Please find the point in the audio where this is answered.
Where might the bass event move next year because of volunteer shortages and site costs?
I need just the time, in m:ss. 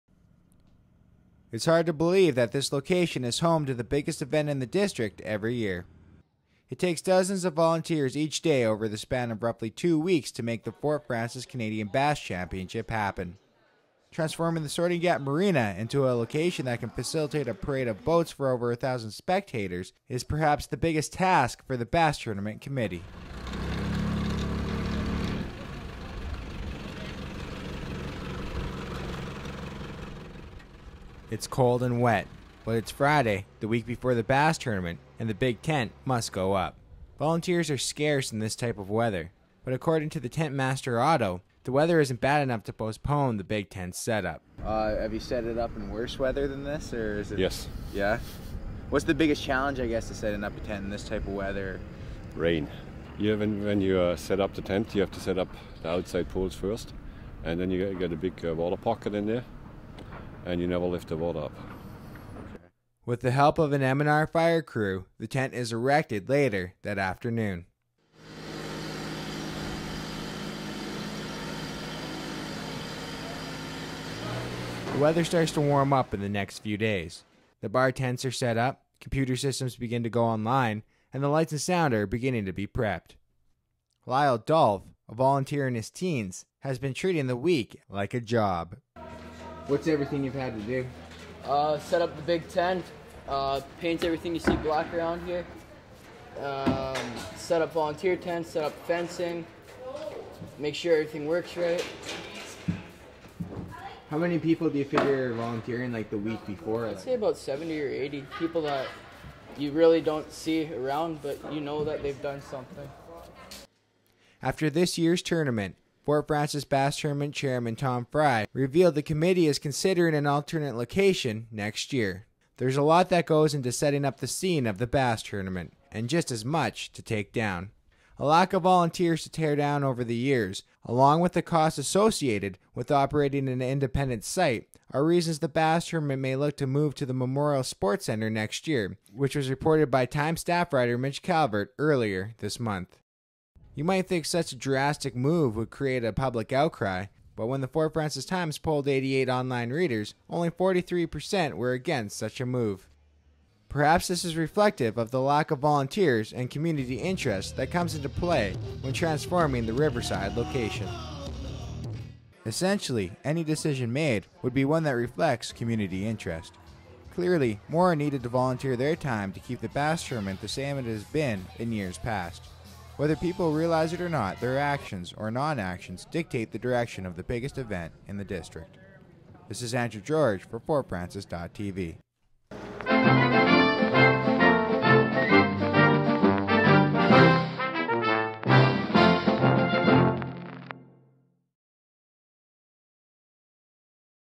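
2:17.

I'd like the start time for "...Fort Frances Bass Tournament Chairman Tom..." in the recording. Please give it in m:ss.
1:56.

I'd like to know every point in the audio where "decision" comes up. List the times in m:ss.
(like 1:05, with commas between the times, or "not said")
2:43.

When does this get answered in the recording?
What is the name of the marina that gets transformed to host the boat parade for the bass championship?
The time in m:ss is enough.
0:14.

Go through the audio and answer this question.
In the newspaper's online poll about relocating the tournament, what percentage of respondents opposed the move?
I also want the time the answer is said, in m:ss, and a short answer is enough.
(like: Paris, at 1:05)
43%, at 2:30.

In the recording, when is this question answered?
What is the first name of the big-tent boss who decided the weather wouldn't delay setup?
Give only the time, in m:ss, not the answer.
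0:40.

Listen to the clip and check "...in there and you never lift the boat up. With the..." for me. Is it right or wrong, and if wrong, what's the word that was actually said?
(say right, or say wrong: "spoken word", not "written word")
right.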